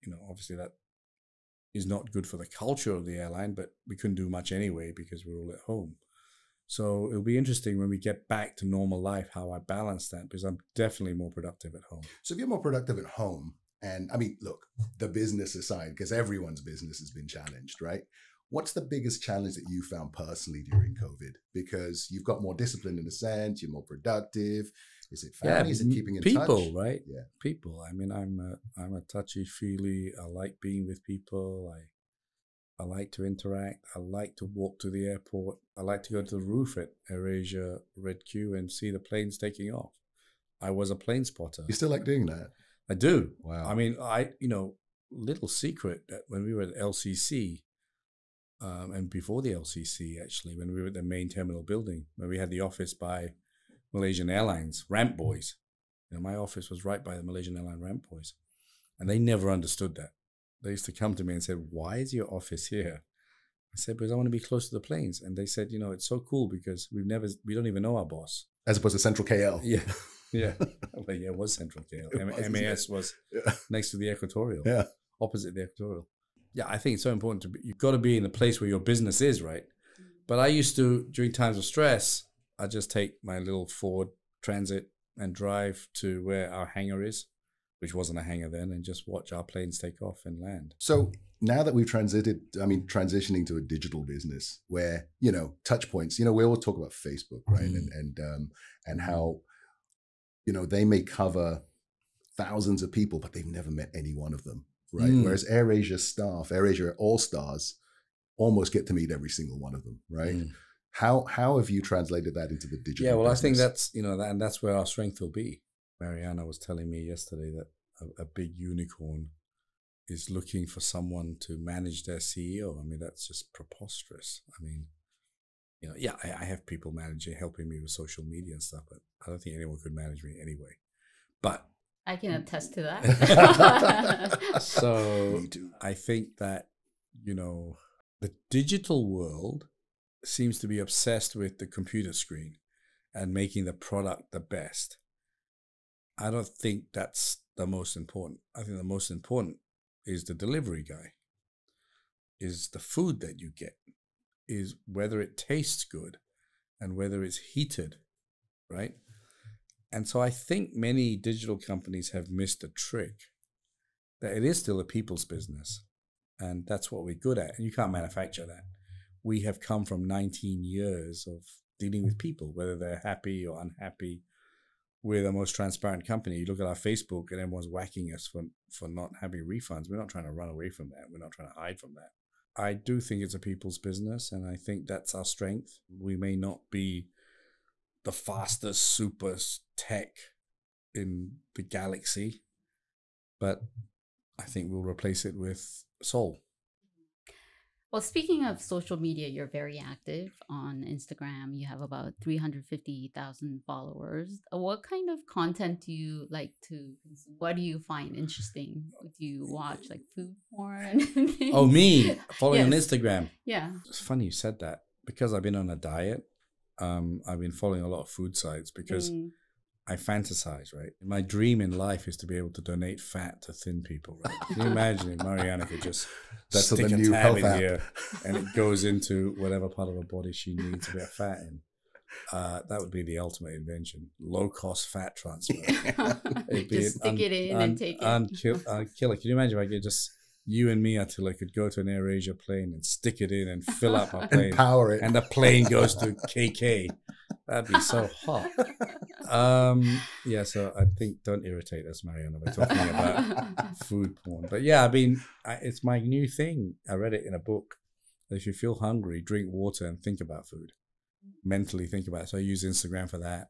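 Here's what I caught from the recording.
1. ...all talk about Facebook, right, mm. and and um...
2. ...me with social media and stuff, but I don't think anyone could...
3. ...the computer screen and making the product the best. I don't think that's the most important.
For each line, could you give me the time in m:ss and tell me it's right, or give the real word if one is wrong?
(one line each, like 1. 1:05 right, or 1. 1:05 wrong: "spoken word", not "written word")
1. 1:36 right
2. 2:07 right
3. 2:21 right.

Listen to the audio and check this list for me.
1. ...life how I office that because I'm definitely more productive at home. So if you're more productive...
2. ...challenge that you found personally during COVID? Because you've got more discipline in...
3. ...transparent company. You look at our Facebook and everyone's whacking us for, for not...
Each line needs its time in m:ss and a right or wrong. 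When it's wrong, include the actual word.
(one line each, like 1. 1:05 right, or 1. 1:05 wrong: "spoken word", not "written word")
1. 0:09 wrong: "balance", not "office"
2. 0:19 right
3. 2:55 right.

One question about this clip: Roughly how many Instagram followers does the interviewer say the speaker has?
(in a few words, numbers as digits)
350,000.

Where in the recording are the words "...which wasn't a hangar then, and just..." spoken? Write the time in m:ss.
1:27.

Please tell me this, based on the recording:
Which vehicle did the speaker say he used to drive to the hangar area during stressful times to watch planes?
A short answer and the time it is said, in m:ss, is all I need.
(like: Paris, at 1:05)
Ford Transit, at 1:23.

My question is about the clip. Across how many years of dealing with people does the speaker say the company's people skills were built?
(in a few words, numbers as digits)
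19 years.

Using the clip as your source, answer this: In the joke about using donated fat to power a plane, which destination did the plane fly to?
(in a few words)
KK.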